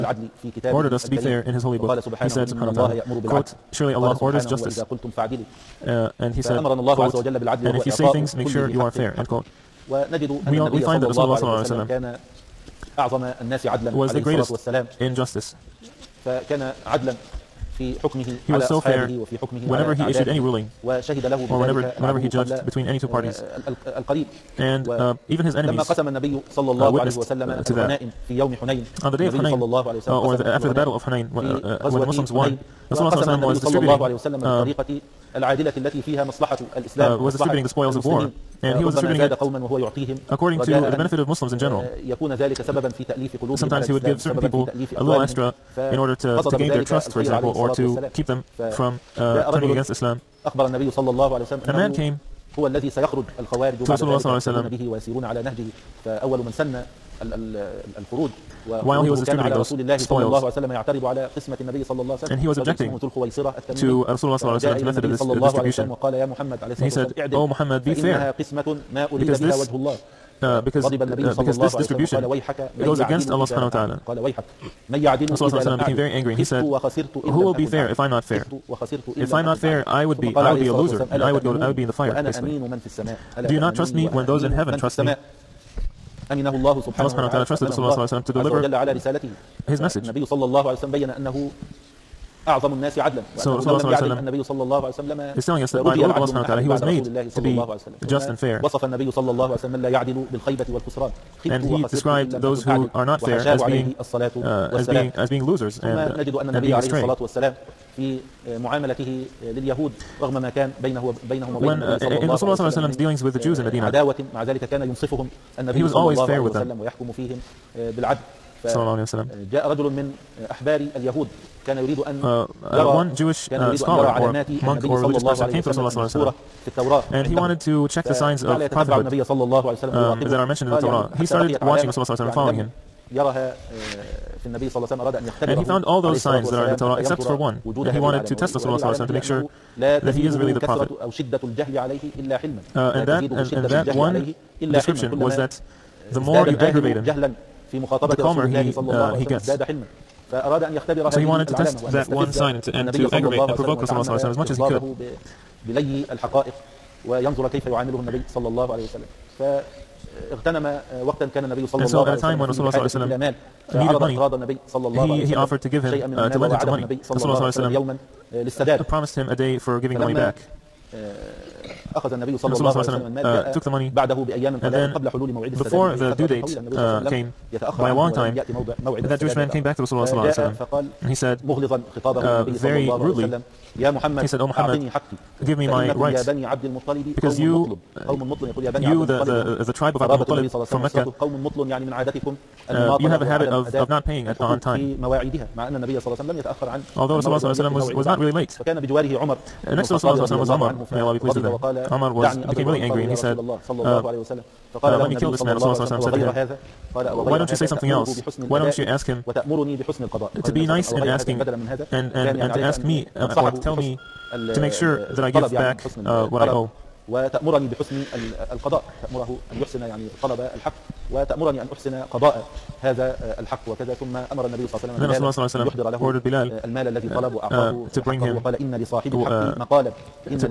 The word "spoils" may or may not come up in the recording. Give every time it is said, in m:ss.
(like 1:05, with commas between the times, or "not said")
0:37, 0:59.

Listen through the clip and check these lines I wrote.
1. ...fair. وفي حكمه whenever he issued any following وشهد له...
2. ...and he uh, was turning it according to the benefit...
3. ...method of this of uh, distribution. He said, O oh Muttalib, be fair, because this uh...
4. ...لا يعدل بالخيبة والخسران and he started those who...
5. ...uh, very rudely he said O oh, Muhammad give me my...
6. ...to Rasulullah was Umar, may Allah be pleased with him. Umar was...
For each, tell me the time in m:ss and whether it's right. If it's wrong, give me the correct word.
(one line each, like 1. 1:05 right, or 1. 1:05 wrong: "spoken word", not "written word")
1. 0:18 wrong: "ruling", not "following"
2. 0:38 wrong: "distributing", not "turning"
3. 1:04 wrong: "Muhammad", not "Muttalib"
4. 1:39 wrong: "described", not "started"
5. 3:02 right
6. 3:19 right.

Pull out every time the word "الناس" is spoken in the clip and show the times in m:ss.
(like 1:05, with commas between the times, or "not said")
0:13, 1:32.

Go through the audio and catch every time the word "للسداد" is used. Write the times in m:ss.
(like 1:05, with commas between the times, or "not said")
2:48.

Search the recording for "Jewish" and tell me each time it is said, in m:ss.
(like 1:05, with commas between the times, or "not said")
2:03, 2:59.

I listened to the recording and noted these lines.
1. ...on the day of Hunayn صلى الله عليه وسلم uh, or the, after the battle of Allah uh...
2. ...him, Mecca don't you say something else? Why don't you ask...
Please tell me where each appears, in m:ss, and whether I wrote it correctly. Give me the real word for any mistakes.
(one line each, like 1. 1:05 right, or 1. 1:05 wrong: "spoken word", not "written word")
1. 0:29 wrong: "Hunayn", not "Allah"
2. 3:26 wrong: "Why", not "Mecca".